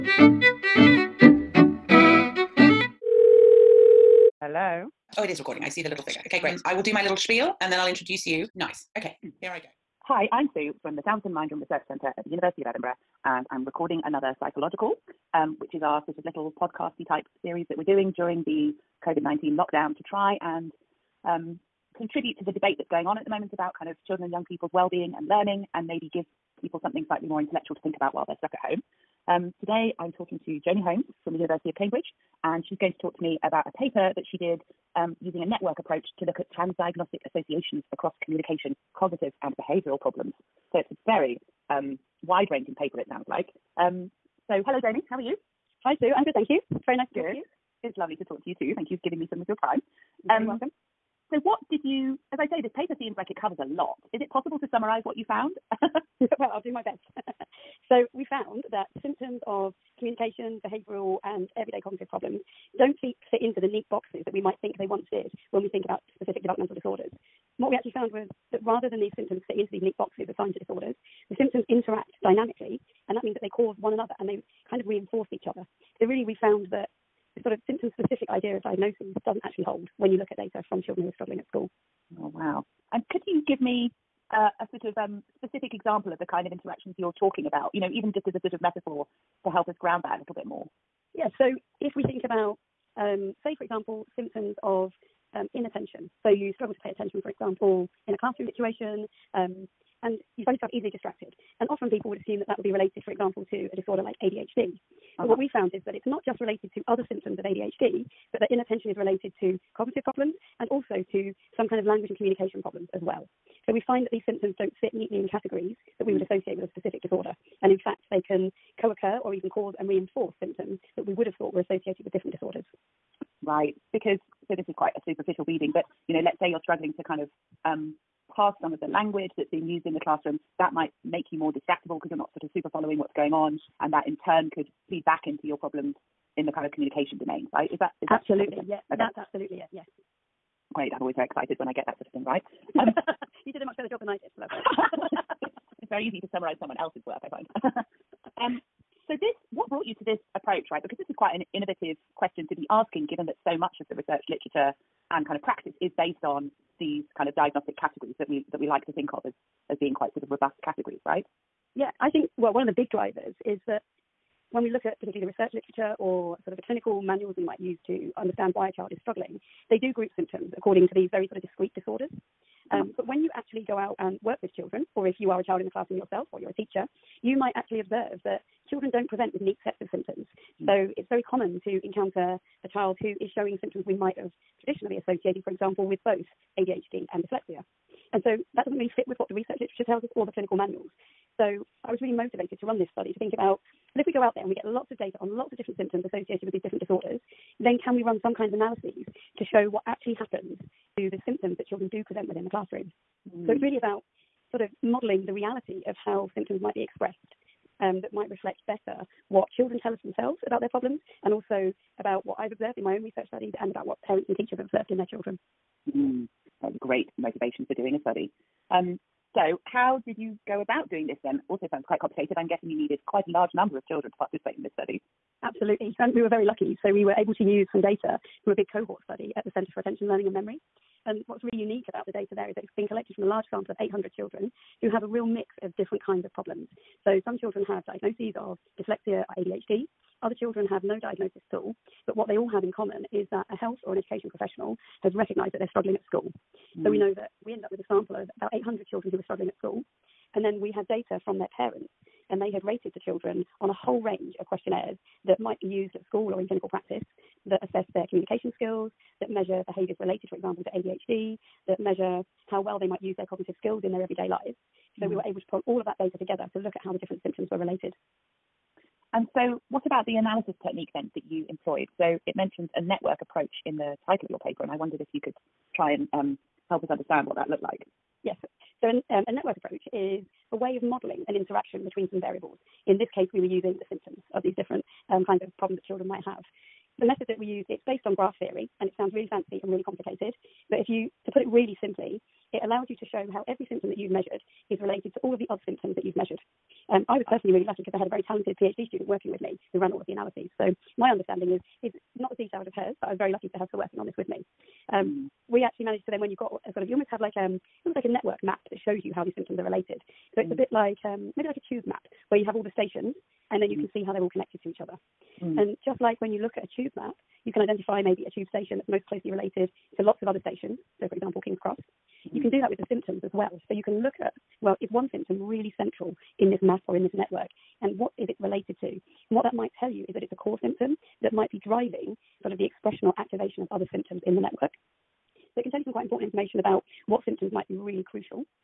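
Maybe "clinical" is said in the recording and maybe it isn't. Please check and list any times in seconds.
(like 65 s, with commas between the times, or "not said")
166 s, 190 s, 256 s.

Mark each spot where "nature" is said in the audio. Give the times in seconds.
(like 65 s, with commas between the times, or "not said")
not said.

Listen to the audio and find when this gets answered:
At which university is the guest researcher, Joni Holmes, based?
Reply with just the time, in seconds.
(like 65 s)
31 s.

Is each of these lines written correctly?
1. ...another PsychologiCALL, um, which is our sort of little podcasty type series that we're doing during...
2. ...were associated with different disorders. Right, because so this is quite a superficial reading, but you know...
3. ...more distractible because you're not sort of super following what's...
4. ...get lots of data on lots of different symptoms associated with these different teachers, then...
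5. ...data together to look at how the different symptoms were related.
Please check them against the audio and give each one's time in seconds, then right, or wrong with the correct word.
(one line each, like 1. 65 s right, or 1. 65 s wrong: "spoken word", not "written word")
1. 14 s right
2. 121 s right
3. 131 s right
4. 194 s wrong: "disorders", not "teachers"
5. 265 s right.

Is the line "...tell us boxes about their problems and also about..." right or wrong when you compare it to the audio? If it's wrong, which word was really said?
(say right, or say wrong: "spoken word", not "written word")
wrong: "themselves", not "boxes".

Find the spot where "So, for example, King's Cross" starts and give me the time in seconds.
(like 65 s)
321 s.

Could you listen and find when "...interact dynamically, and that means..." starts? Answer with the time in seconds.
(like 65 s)
71 s.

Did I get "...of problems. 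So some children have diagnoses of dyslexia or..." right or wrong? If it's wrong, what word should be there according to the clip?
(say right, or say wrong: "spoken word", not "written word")
right.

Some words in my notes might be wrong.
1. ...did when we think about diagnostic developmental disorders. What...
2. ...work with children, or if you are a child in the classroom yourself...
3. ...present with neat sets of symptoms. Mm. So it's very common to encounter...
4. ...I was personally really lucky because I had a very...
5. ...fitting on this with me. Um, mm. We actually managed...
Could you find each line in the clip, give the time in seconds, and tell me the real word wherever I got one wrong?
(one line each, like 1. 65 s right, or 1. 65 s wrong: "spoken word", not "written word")
1. 65 s wrong: "specific", not "diagnostic"
2. 174 s right
3. 179 s right
4. 297 s right
5. 303 s wrong: "working", not "fitting".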